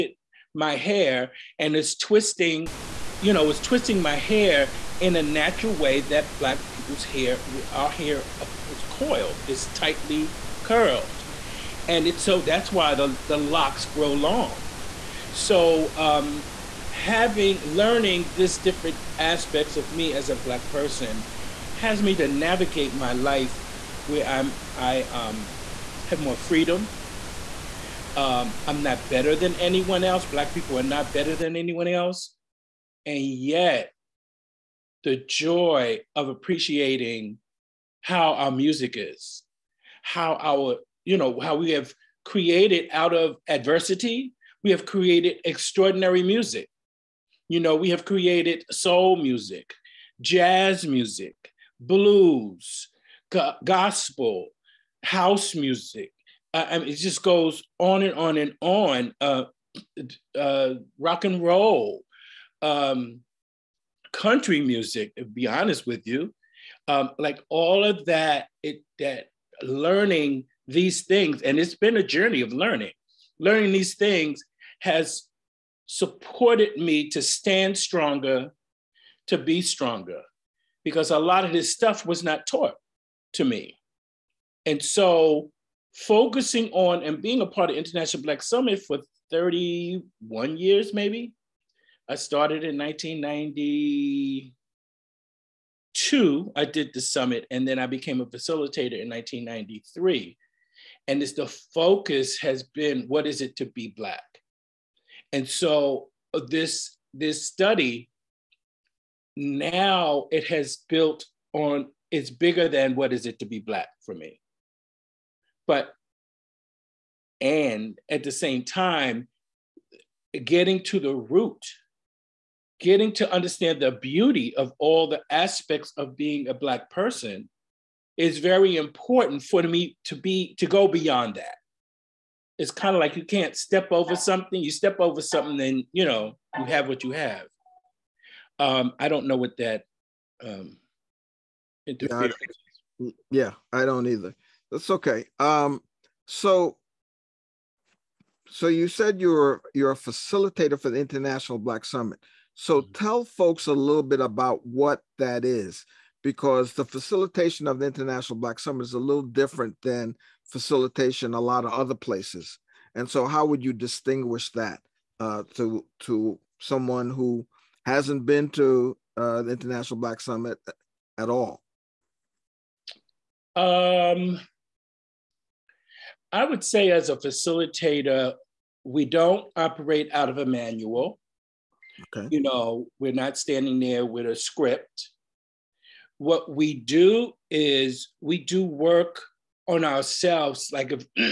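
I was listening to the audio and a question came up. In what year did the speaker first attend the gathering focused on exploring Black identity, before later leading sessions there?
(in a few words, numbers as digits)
1992.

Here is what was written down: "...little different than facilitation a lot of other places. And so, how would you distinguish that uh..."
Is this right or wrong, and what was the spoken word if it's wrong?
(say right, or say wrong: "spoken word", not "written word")
right.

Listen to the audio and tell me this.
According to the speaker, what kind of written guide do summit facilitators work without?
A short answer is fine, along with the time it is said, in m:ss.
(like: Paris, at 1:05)
A manual, at 3:00.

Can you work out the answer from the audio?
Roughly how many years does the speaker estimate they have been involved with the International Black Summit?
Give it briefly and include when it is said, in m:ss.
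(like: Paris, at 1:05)
31, at 1:29.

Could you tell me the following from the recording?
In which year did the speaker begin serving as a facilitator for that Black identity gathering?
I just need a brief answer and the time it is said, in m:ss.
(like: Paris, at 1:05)
1993, at 1:39.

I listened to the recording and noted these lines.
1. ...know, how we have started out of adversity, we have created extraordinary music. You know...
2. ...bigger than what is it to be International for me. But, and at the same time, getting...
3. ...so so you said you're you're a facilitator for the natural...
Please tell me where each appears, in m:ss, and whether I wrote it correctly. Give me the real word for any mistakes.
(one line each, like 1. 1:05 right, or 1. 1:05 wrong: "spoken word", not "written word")
1. 0:41 wrong: "created", not "started"
2. 1:52 wrong: "Black", not "International"
3. 2:26 wrong: "international", not "natural".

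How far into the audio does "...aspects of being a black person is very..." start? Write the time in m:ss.
2:05.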